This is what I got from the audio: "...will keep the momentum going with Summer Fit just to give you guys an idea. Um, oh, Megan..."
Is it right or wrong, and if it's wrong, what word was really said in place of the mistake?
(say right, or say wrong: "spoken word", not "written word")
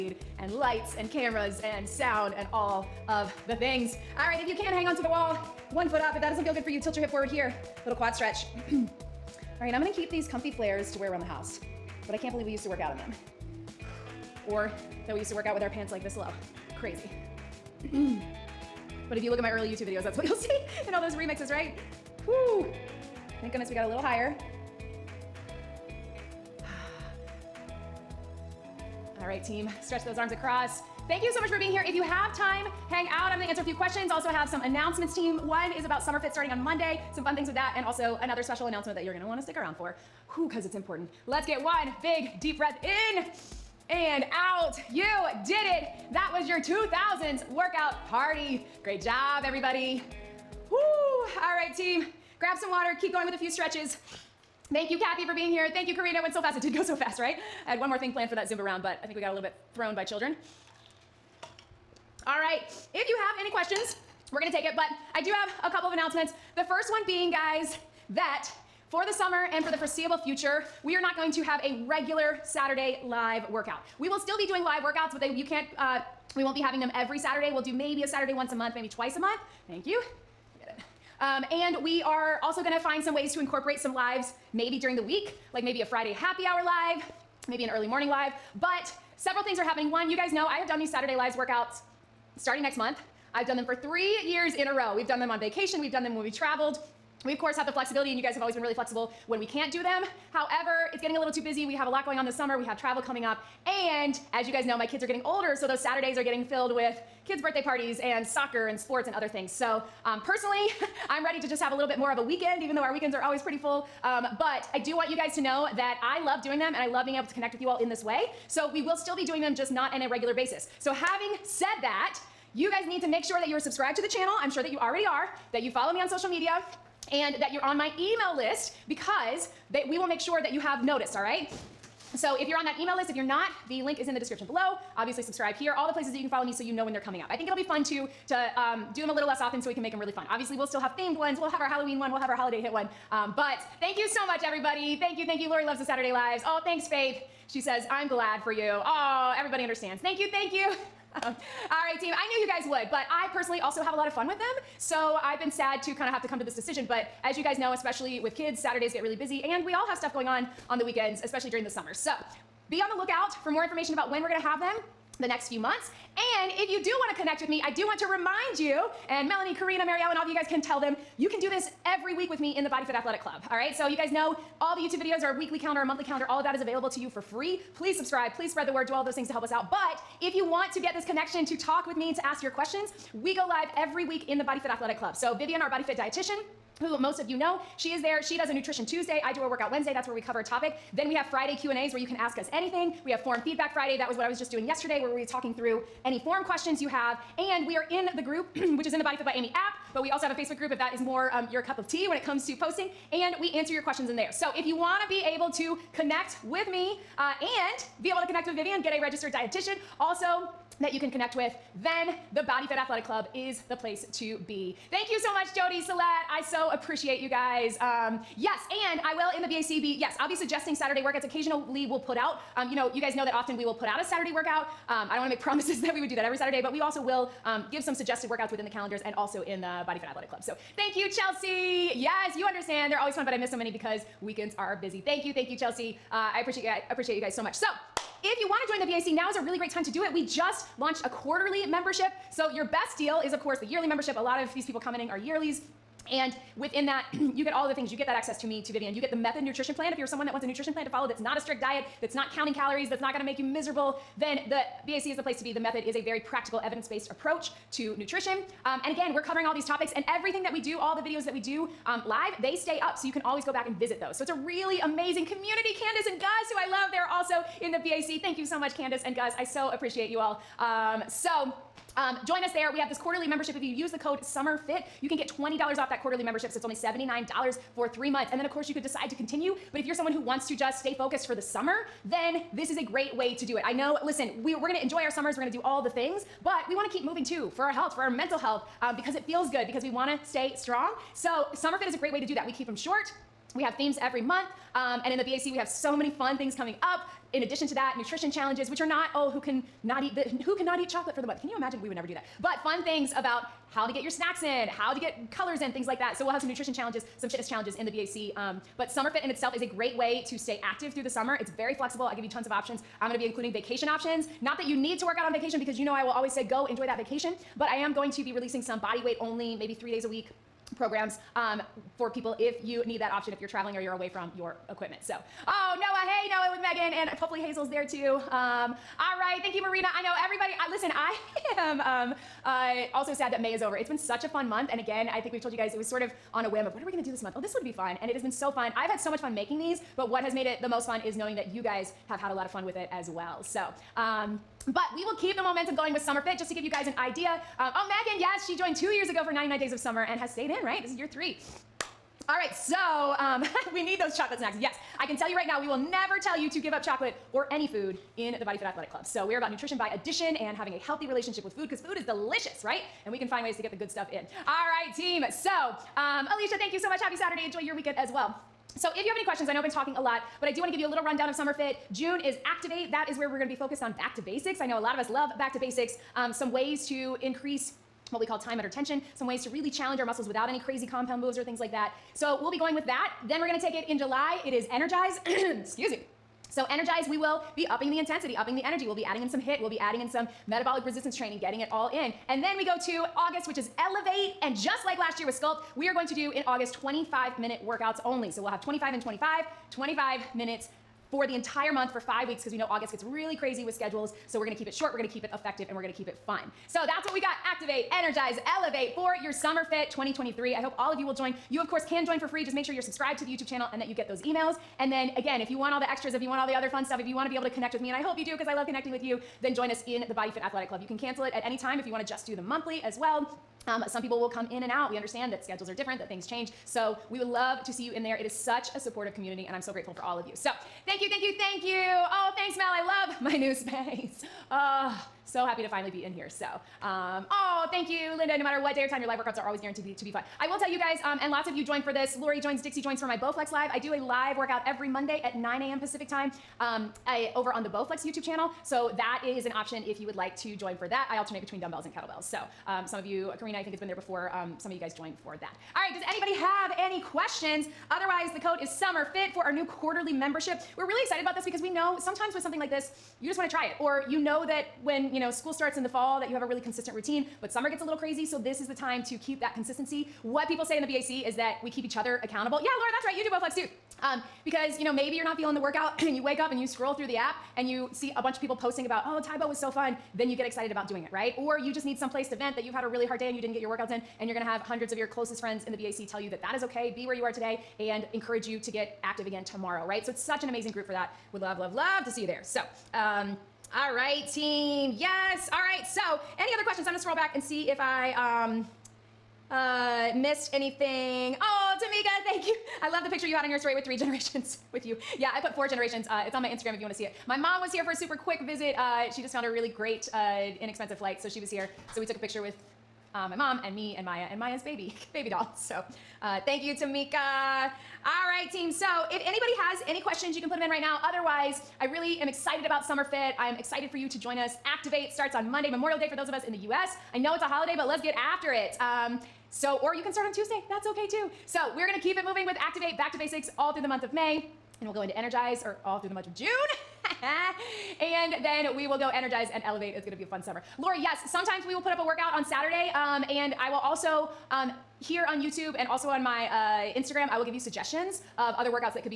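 right.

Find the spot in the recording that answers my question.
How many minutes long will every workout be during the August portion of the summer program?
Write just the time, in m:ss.
6:36.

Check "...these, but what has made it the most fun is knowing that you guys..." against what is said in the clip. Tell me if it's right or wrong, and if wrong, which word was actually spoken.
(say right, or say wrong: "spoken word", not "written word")
right.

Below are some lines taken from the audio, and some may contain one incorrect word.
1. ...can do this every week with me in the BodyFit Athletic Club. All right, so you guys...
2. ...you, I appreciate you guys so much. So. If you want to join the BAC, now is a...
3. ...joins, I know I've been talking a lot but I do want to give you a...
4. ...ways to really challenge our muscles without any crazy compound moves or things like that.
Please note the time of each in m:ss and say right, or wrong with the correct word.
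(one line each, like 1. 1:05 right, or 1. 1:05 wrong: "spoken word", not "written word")
1. 2:51 right
2. 3:56 right
3. 6:09 wrong: "questions", not "joins"
4. 6:19 right.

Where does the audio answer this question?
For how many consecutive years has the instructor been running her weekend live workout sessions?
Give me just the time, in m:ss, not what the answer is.
1:33.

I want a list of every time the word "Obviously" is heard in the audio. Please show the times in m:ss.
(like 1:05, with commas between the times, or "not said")
2:14, 2:20.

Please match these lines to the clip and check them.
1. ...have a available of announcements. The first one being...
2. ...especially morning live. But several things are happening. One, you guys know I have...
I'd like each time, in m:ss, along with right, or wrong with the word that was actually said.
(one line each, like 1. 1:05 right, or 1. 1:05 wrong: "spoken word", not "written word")
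1. 1:05 wrong: "couple", not "available"
2. 1:27 wrong: "early", not "especially".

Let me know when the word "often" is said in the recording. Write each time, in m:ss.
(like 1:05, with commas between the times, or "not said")
2:19, 3:43.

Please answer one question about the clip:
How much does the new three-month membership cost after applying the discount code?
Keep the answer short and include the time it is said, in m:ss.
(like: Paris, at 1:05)
$79, at 4:36.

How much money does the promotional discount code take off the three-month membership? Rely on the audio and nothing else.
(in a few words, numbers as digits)
$20.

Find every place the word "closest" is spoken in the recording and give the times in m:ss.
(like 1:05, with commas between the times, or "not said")
8:05.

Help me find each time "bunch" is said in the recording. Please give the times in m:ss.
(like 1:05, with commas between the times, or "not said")
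7:58.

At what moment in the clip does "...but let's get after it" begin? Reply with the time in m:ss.
8:47.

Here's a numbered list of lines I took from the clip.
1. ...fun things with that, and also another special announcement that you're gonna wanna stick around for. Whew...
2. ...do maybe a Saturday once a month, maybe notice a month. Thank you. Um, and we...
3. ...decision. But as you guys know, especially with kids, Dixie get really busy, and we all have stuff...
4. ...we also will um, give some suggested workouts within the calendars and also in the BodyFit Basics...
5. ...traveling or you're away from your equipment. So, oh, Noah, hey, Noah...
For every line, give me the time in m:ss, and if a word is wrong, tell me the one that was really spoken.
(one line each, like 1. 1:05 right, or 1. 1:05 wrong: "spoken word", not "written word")
1. 0:37 right
2. 1:17 wrong: "twice", not "notice"
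3. 2:36 wrong: "Saturdays", not "Dixie"
4. 3:46 wrong: "Athletic", not "Basics"
5. 5:23 right.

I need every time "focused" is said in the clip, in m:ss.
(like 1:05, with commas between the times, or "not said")
4:40, 6:13.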